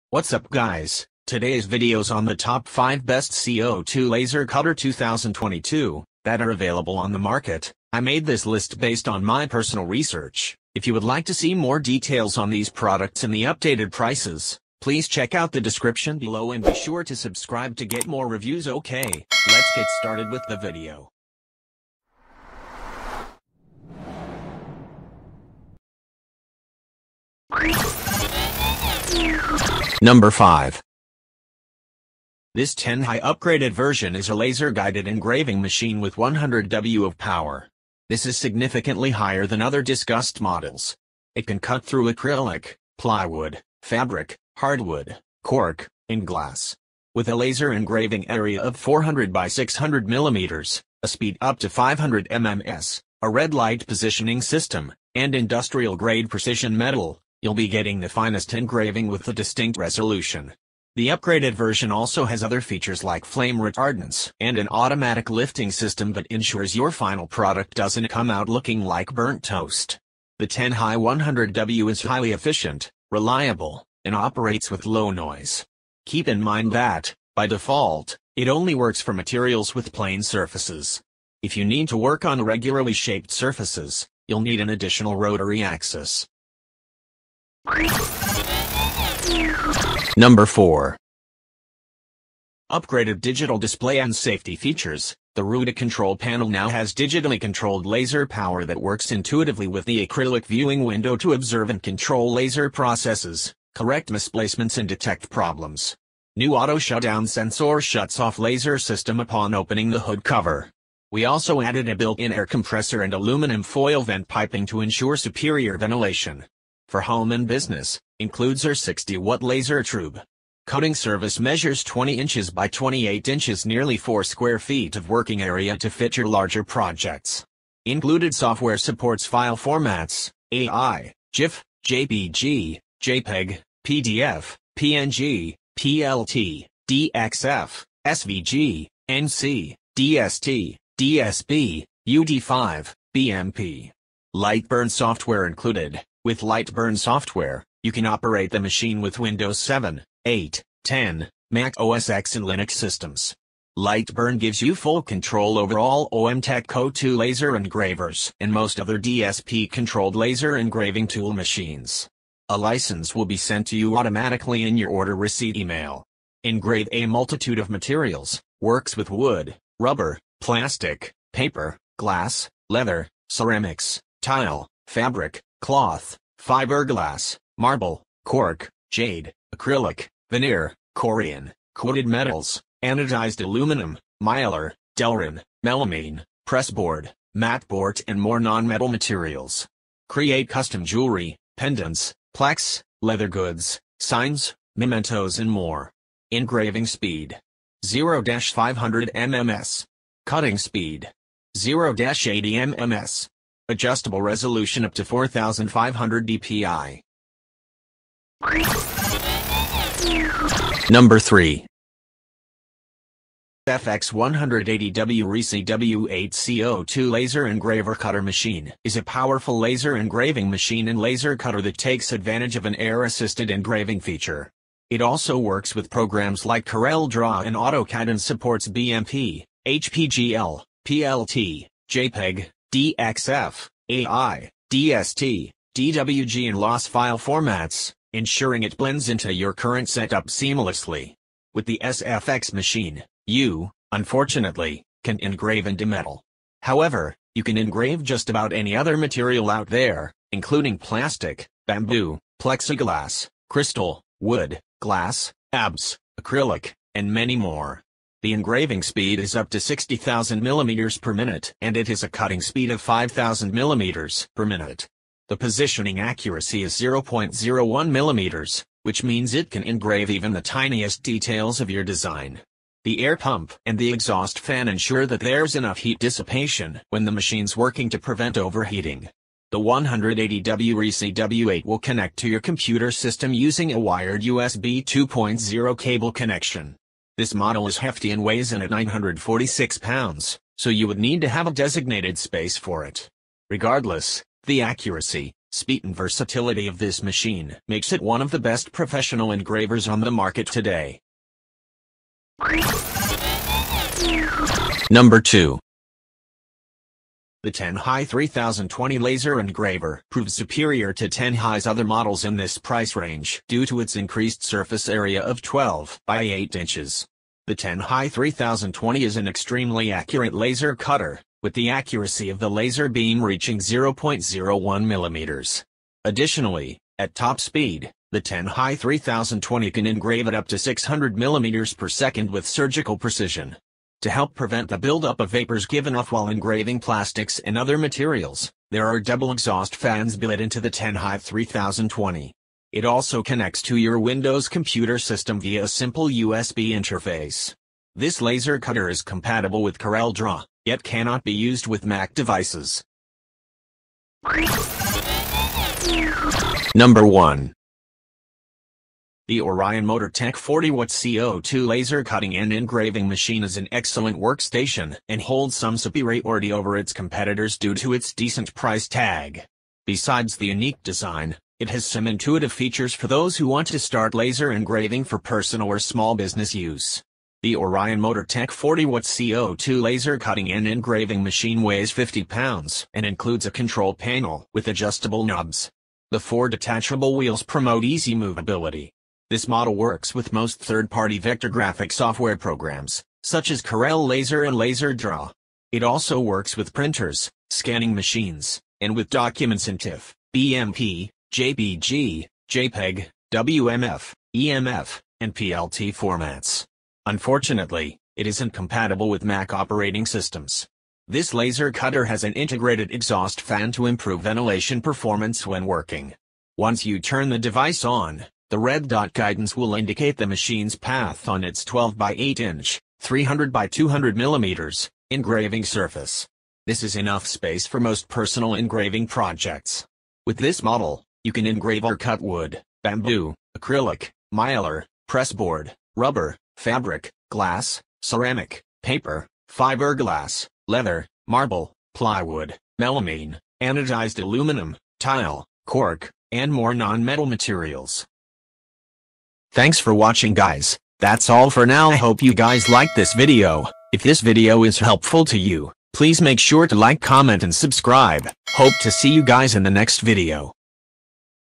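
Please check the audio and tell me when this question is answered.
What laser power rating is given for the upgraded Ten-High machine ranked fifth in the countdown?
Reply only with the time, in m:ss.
0:36.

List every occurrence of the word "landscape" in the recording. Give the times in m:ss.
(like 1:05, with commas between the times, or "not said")
not said.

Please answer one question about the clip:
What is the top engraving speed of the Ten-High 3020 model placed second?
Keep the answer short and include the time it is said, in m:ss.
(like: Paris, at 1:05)
600 mm per second, at 5:30.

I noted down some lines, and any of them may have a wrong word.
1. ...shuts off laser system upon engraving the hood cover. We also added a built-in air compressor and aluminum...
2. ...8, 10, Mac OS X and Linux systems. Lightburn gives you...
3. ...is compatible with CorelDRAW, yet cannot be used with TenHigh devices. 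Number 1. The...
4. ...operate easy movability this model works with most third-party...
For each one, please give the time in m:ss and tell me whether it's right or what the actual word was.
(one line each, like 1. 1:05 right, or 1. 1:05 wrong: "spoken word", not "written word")
1. 1:47 wrong: "opening", not "engraving"
2. 2:30 right
3. 5:48 wrong: "Mac", not "TenHigh"
4. 6:27 wrong: "promote", not "operate".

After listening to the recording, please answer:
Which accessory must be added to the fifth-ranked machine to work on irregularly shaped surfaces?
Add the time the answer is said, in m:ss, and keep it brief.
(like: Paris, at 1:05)
Rotary axis, at 1:24.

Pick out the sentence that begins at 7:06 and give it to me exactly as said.
This is enough space for most personal engraving projects.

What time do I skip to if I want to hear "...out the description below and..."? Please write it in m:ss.
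0:15.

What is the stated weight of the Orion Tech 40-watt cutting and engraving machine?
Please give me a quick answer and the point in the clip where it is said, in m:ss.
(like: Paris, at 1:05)
50 pounds, at 6:21.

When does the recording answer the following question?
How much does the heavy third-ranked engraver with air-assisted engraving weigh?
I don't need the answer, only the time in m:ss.
4:48.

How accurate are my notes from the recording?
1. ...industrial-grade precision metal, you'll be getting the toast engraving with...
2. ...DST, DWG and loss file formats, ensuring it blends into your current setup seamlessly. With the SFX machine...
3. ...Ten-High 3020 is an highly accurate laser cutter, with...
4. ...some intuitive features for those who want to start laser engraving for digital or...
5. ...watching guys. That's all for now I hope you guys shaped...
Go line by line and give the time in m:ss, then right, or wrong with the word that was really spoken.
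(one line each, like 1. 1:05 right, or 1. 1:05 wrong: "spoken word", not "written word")
1. 0:55 wrong: "finest", not "toast"
2. 3:54 right
3. 5:17 wrong: "extremely", not "highly"
4. 6:11 wrong: "personal", not "digital"
5. 7:29 wrong: "liked", not "shaped".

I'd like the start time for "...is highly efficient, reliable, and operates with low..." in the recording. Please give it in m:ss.
1:11.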